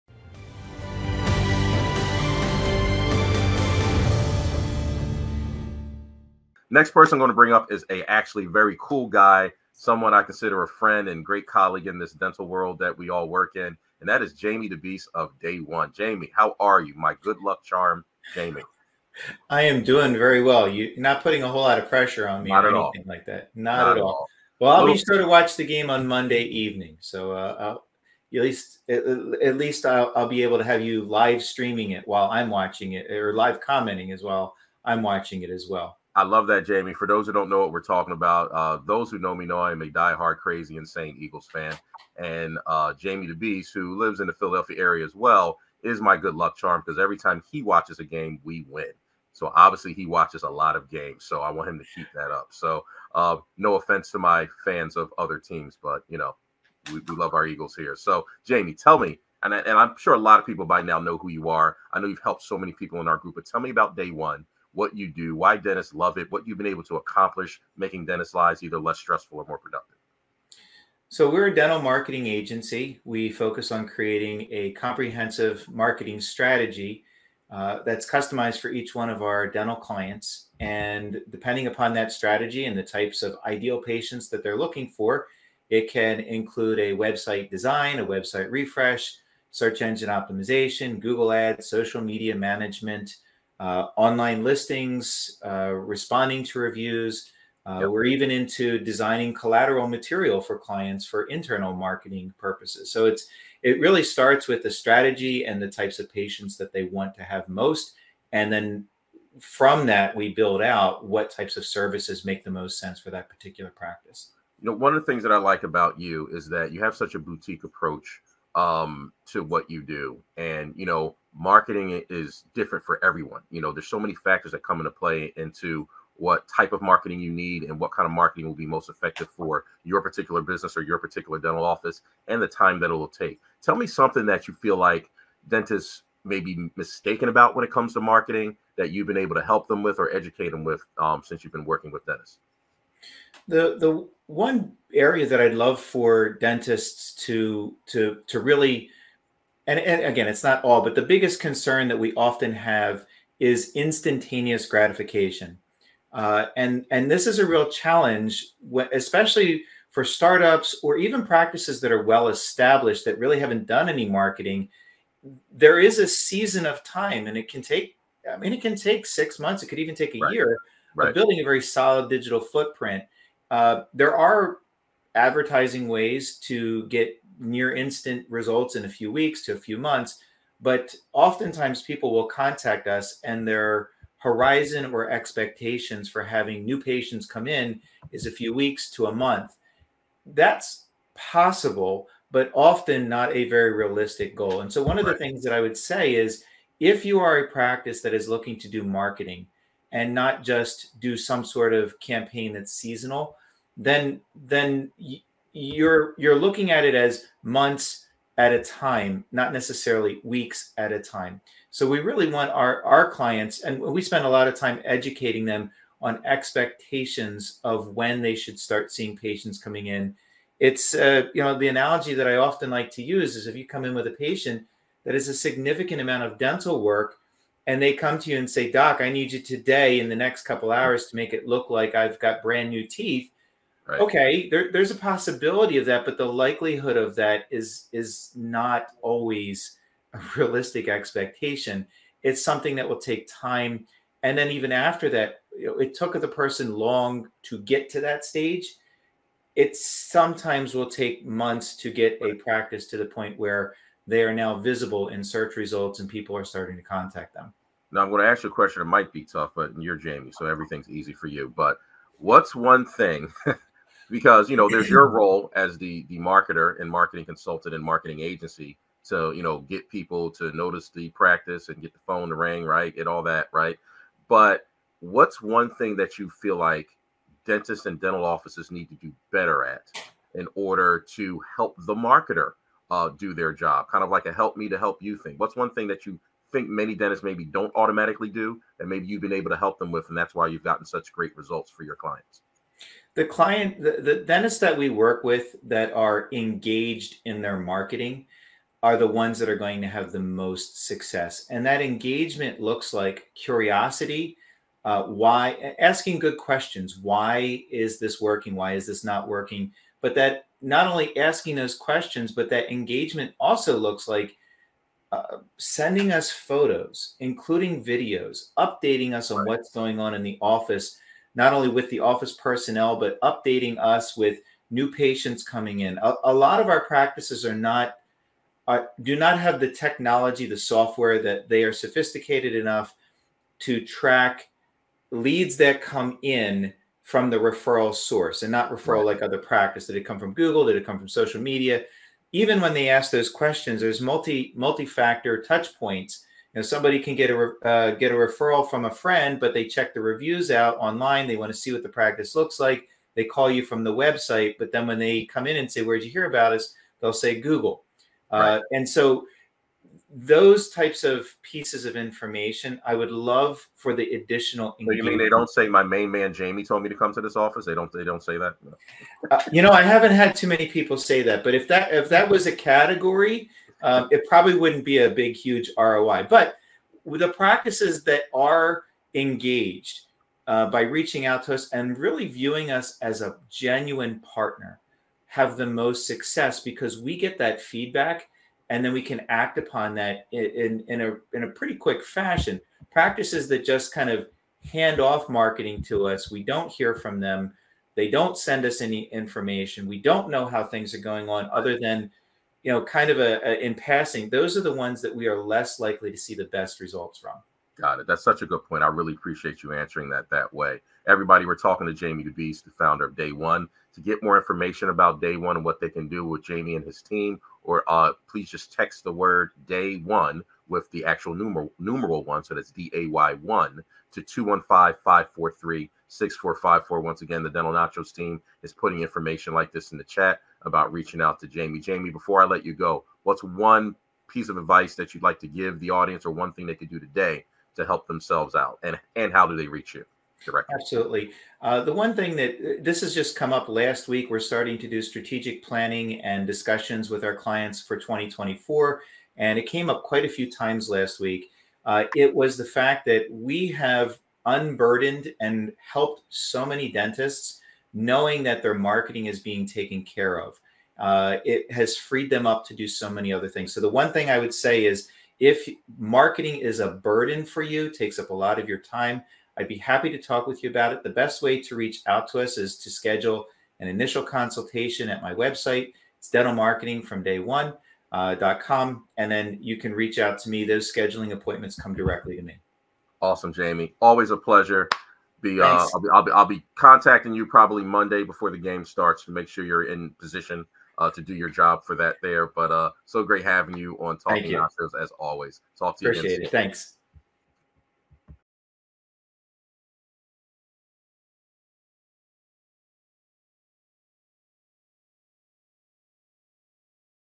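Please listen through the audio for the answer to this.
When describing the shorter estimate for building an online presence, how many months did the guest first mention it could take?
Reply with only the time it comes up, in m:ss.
2:49.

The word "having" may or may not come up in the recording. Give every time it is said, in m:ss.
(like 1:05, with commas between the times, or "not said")
3:06, 8:13.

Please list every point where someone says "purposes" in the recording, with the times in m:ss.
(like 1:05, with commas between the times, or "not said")
1:42.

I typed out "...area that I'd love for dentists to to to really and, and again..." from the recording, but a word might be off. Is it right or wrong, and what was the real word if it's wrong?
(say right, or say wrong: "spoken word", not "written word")
right.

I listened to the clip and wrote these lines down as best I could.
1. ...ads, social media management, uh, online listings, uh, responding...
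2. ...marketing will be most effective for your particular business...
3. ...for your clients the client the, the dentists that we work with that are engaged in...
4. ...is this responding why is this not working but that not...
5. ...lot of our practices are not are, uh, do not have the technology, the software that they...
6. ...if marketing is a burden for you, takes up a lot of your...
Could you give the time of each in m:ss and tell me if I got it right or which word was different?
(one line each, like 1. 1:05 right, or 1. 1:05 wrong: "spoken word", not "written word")
1. 1:31 right
2. 2:08 right
3. 4:51 right
4. 5:07 wrong: "working", not "responding"
5. 5:26 right
6. 7:45 right.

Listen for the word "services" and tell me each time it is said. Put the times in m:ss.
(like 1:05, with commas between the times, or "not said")
1:51.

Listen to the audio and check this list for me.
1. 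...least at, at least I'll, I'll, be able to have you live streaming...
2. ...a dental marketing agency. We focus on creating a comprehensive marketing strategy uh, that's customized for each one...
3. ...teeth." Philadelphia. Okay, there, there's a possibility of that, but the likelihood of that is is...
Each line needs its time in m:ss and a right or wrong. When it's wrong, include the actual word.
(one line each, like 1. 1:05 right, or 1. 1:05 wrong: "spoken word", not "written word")
1. 0:28 right
2. 1:11 right
3. 3:52 wrong: "Right", not "Philadelphia".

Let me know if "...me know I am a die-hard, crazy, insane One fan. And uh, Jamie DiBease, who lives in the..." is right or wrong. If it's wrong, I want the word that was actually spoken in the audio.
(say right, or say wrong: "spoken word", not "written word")
wrong: "Eagles", not "One".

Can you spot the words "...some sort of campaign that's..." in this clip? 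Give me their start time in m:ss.
3:21.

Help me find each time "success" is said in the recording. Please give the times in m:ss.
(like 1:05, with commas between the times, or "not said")
5:00, 6:26.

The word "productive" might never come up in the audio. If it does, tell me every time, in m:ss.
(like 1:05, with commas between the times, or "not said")
1:09.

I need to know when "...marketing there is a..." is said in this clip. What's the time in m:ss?
2:44.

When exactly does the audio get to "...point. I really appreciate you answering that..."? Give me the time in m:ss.
6:48.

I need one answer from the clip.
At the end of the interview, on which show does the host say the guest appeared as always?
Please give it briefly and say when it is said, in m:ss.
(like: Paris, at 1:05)
Talking Nachos, at 8:14.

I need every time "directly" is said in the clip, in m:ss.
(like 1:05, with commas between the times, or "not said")
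7:20, 8:01.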